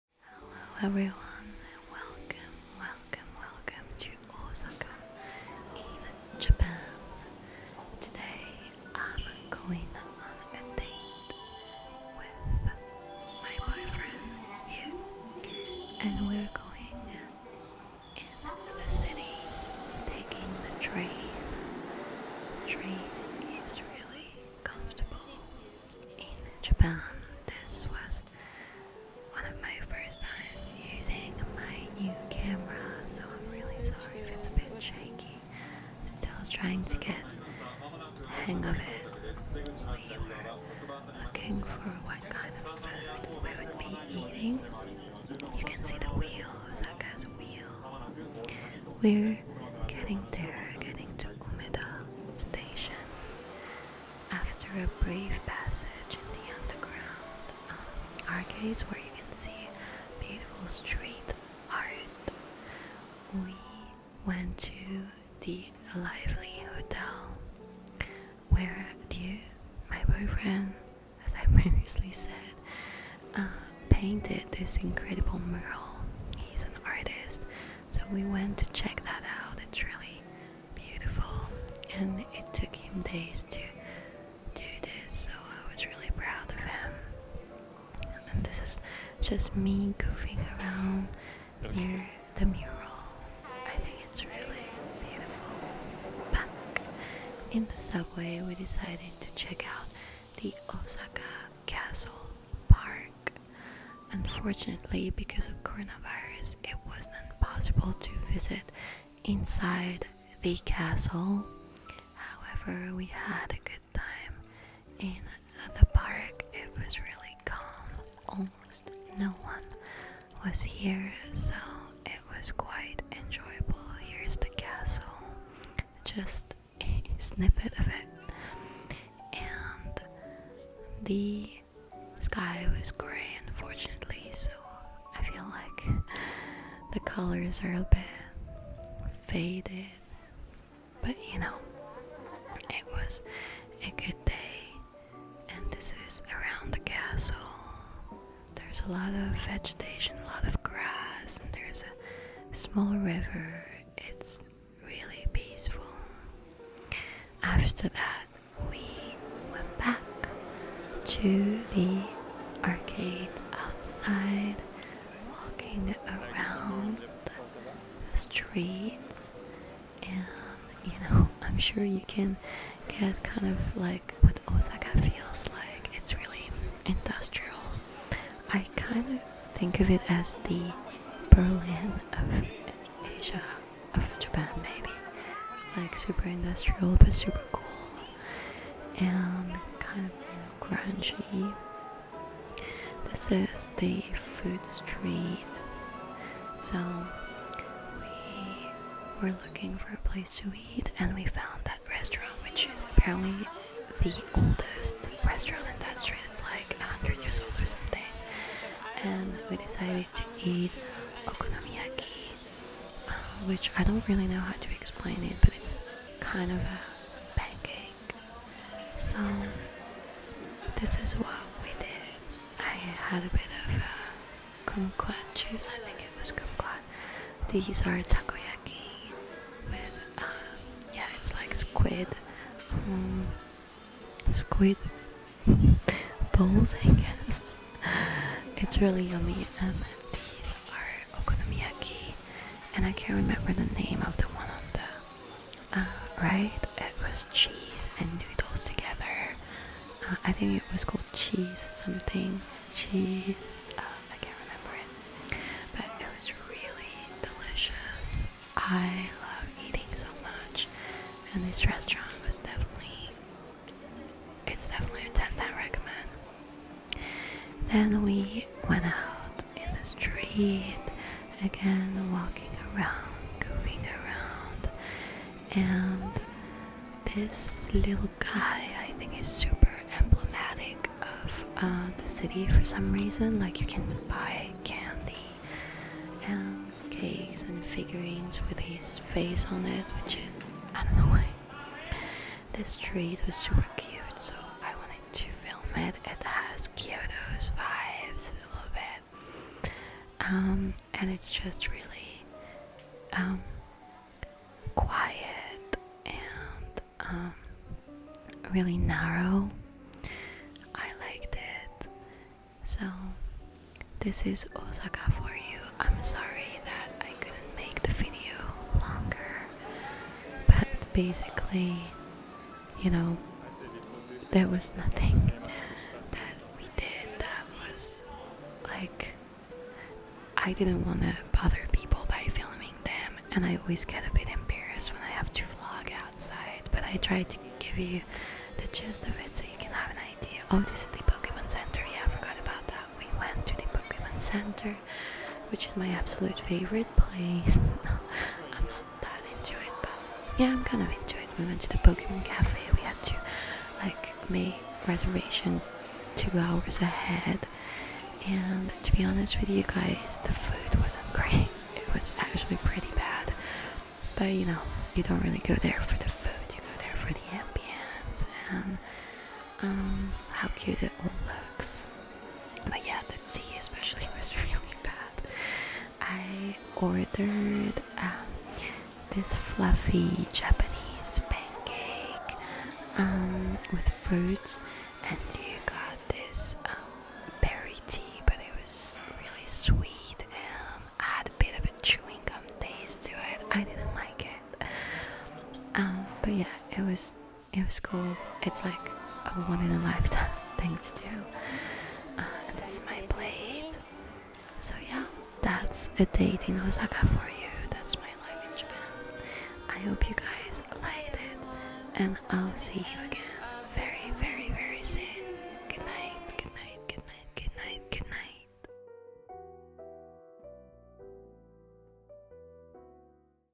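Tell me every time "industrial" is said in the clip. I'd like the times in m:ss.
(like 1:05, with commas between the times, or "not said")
2:56, 3:06.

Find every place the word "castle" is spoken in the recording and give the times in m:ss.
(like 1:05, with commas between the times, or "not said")
1:50, 2:04, 2:26.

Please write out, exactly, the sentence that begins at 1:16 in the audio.
He's an artist, so we went to check that out.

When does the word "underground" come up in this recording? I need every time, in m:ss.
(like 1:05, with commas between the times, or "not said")
0:56.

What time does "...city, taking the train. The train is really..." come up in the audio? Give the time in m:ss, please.
0:18.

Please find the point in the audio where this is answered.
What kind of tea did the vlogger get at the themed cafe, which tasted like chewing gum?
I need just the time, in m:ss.
6:27.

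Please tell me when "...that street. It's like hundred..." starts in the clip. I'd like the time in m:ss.
3:25.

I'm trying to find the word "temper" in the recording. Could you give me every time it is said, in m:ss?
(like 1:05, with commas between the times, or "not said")
not said.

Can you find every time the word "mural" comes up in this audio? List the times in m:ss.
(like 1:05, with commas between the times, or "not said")
1:15, 1:32.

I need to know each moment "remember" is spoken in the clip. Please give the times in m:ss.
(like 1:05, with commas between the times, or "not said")
4:03, 4:14.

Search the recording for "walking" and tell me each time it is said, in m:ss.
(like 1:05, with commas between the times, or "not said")
2:45, 4:32.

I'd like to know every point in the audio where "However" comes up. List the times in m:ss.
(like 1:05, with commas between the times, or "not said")
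1:52.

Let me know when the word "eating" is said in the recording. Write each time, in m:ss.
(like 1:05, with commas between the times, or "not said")
0:44, 4:19.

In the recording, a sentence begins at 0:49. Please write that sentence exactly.
We're getting there, getting to Umeda station.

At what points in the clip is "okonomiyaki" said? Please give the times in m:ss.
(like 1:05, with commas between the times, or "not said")
3:31, 4:01.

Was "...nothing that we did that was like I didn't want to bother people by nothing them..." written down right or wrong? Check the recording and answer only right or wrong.
wrong.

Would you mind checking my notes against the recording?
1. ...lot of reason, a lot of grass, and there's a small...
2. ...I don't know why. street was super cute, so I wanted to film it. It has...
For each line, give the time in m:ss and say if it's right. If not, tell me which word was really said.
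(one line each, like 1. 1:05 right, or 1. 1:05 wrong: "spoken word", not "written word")
1. 2:28 wrong: "vegetation", not "reason"
2. 4:50 right.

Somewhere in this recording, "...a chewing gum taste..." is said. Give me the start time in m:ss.
6:31.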